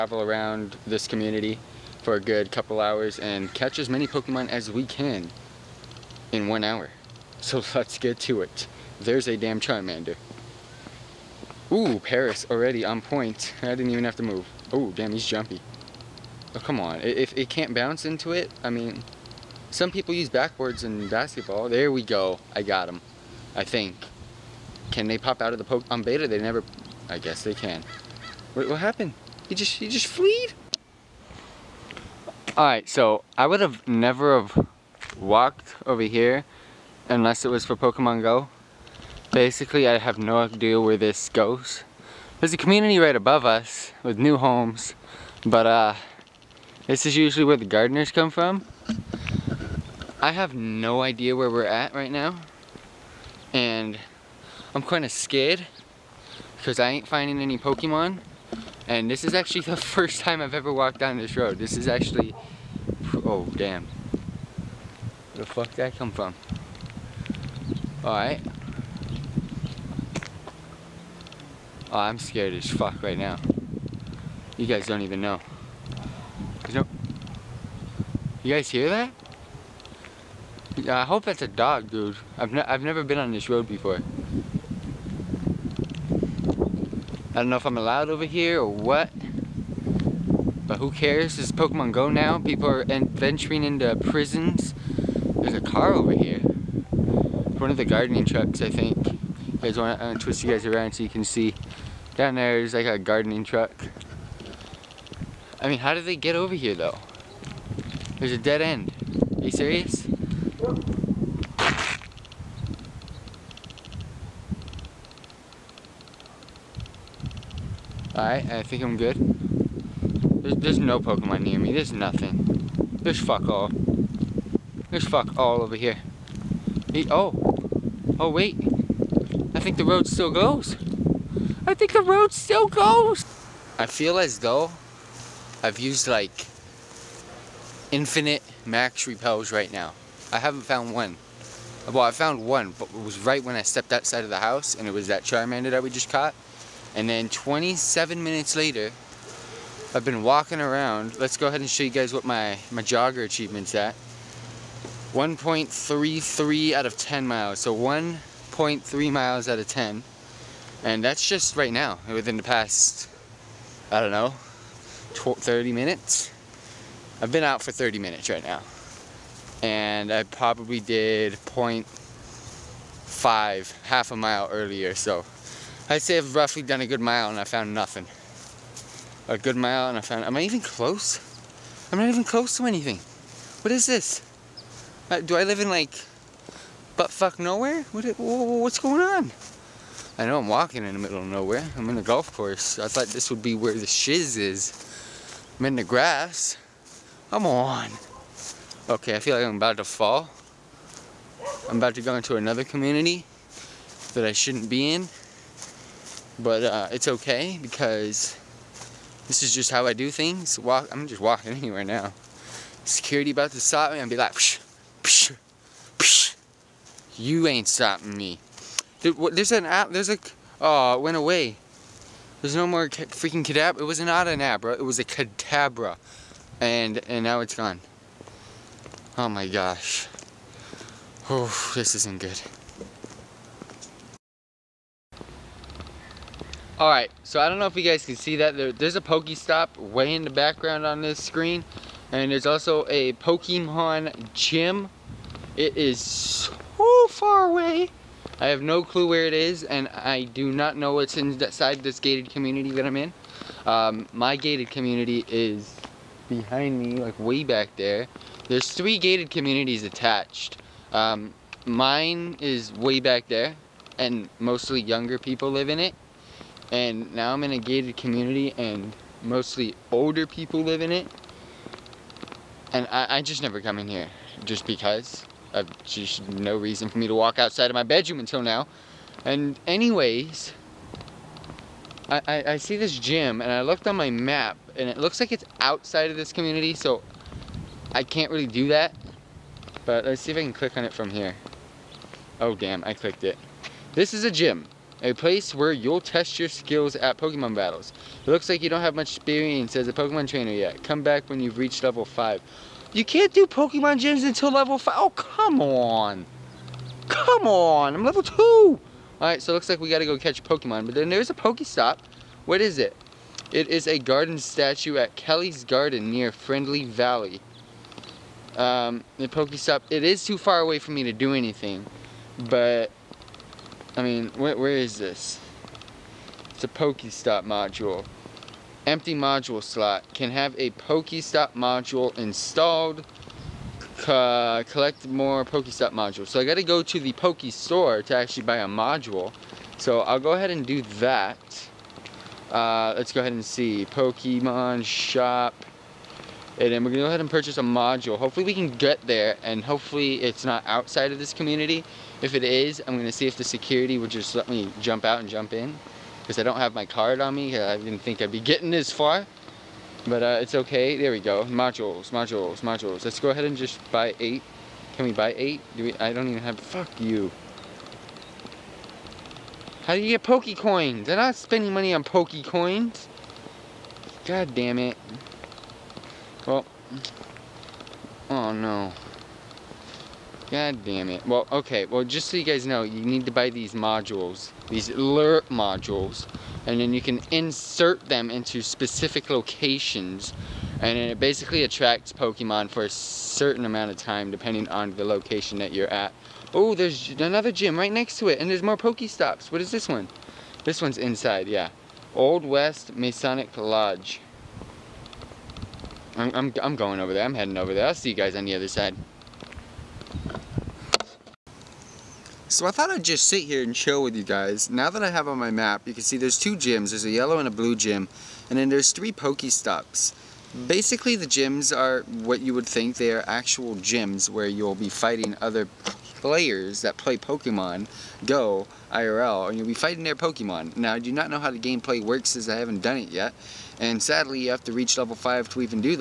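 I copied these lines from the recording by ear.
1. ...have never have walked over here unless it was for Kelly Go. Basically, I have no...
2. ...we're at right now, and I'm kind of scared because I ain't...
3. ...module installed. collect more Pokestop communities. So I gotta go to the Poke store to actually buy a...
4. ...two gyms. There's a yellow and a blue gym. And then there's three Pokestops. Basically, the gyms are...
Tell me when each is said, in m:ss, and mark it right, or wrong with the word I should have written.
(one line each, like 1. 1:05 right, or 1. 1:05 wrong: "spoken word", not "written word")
1. 0:33 wrong: "Pokemon", not "Kelly"
2. 0:51 right
3. 5:31 wrong: "modules", not "communities"
4. 6:56 right.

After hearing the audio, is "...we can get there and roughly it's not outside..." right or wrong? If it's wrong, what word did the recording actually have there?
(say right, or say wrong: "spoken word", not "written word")
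wrong: "hopefully", not "roughly".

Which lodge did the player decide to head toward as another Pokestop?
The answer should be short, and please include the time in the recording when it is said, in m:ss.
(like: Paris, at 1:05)
Old West Masonic Lodge, at 6:42.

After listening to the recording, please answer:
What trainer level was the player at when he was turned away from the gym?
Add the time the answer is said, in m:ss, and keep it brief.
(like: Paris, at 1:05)
level 2, at 5:08.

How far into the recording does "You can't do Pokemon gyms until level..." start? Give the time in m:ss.
5:02.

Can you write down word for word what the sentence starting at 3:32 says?
Security about to stop me, i be like, psh, psh, psh.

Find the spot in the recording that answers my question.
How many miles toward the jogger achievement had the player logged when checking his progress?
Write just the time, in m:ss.
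2:35.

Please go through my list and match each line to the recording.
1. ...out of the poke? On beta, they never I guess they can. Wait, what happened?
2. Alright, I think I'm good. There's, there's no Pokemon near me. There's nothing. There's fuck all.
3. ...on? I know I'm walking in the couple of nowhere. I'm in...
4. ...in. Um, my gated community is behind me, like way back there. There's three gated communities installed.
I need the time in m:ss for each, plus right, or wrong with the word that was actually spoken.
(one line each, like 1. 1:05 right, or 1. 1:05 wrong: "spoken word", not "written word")
1. 0:25 right
2. 1:58 right
3. 3:09 wrong: "middle", not "couple"
4. 4:12 wrong: "attached", not "installed".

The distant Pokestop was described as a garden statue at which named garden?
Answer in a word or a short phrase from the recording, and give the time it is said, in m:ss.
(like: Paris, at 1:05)
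Kelly's Garden, at 5:15.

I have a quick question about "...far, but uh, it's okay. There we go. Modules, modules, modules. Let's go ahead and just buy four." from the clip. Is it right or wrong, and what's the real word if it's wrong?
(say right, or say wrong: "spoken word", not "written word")
wrong: "eight", not "four".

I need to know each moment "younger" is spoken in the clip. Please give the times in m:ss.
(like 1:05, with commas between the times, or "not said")
4:24.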